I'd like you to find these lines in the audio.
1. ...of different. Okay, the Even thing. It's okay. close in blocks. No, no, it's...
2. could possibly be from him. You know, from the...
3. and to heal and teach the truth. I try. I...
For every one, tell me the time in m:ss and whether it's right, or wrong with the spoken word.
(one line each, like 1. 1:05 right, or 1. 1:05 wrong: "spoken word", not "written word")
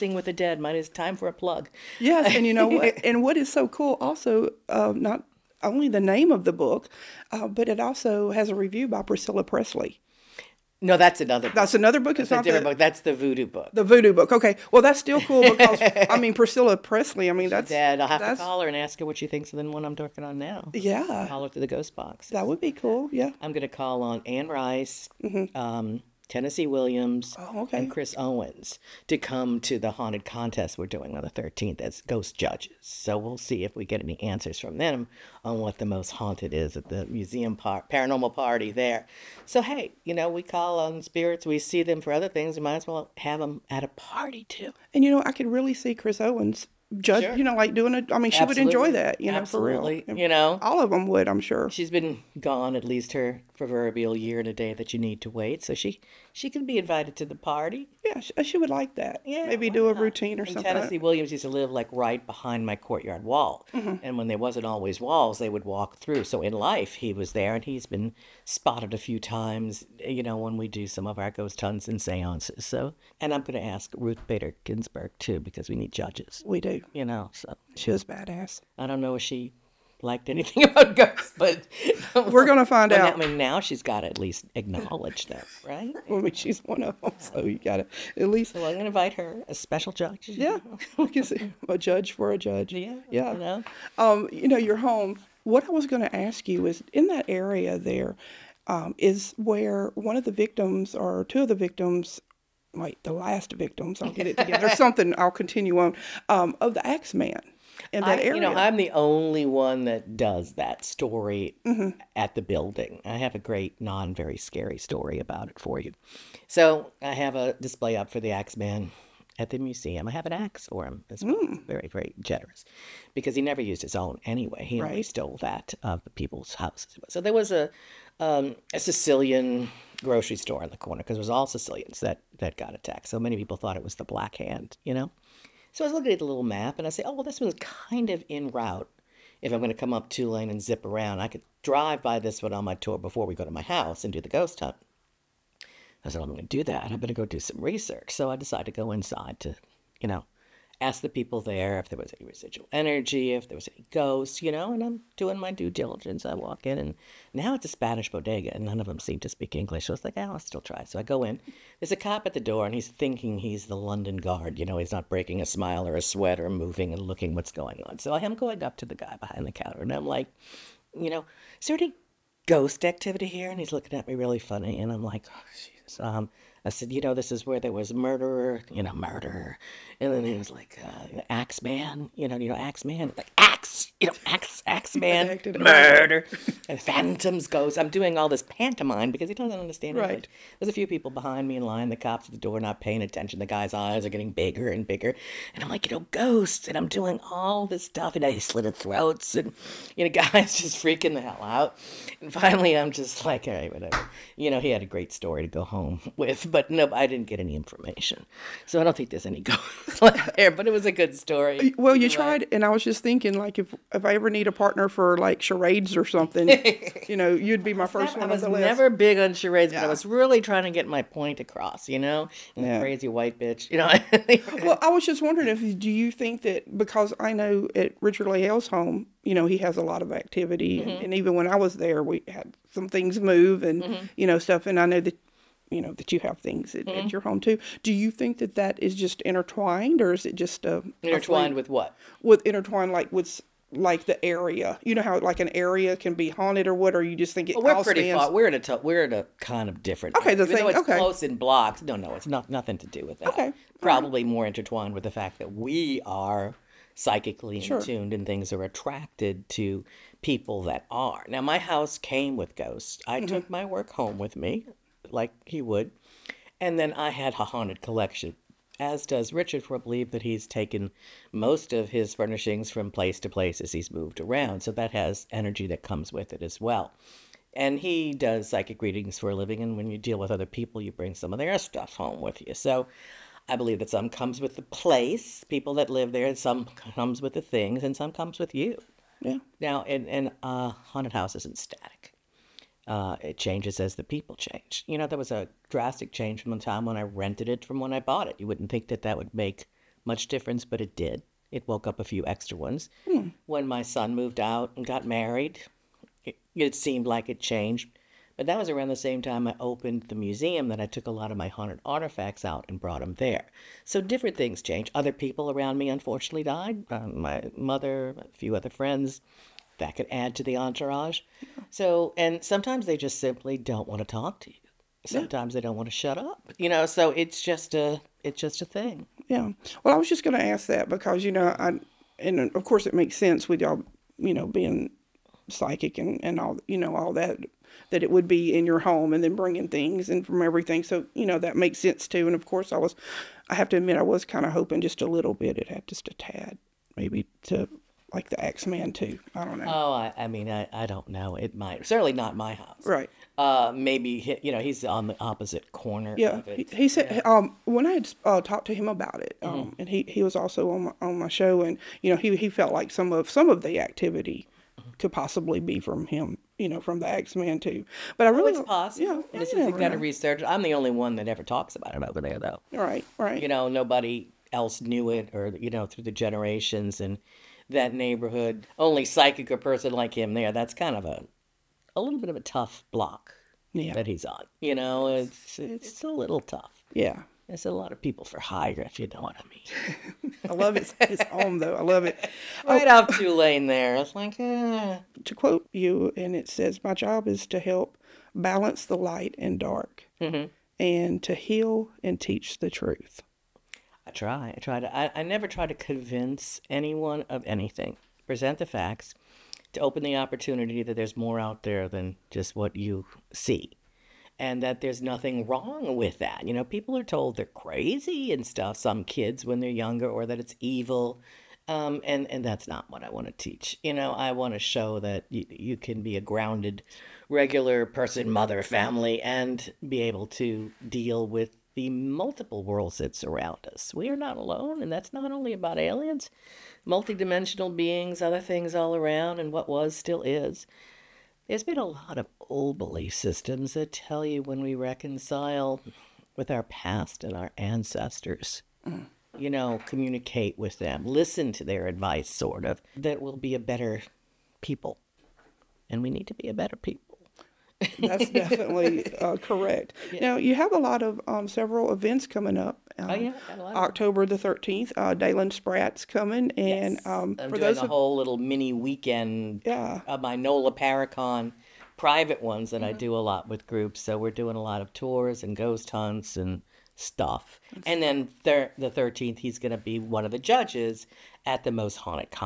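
1. 4:09 right
2. 6:04 right
3. 6:40 right.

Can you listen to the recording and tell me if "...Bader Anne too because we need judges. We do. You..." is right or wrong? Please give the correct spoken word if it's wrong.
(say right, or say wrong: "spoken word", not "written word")
wrong: "Ginsburg", not "Anne".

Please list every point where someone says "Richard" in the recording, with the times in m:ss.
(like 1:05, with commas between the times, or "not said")
3:48, 4:29.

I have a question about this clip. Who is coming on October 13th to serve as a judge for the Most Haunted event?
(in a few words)
Dalen Spratt.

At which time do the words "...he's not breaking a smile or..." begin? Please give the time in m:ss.
2:44.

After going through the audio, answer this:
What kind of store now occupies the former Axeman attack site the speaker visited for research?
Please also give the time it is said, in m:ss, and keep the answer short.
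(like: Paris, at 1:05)
Spanish bodega, at 2:37.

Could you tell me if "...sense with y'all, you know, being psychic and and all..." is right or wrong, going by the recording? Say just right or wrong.
right.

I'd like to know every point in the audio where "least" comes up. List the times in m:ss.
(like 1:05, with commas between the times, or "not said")
0:52, 1:24, 1:28.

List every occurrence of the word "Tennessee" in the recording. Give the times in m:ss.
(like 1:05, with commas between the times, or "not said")
0:26, 1:00.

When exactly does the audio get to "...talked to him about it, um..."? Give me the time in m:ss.
5:58.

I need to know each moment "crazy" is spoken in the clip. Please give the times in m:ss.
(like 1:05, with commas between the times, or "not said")
3:42, 6:57.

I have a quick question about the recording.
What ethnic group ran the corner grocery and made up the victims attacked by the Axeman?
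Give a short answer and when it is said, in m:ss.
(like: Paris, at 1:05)
Sicilians, at 2:11.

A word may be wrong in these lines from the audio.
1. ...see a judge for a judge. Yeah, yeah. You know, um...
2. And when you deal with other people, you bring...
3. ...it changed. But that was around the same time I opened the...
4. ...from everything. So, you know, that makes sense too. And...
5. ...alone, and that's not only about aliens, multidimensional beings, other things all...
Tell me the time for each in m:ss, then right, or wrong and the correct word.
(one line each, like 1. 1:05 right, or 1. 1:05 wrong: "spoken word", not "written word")
1. 1:31 right
2. 4:39 right
3. 5:07 right
4. 5:40 right
5. 7:14 right.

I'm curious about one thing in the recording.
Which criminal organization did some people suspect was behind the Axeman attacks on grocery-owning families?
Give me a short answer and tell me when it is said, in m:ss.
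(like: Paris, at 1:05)
the Black Hand, at 2:13.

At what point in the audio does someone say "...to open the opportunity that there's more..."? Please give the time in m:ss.
6:49.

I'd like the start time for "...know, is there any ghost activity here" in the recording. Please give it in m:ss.
2:51.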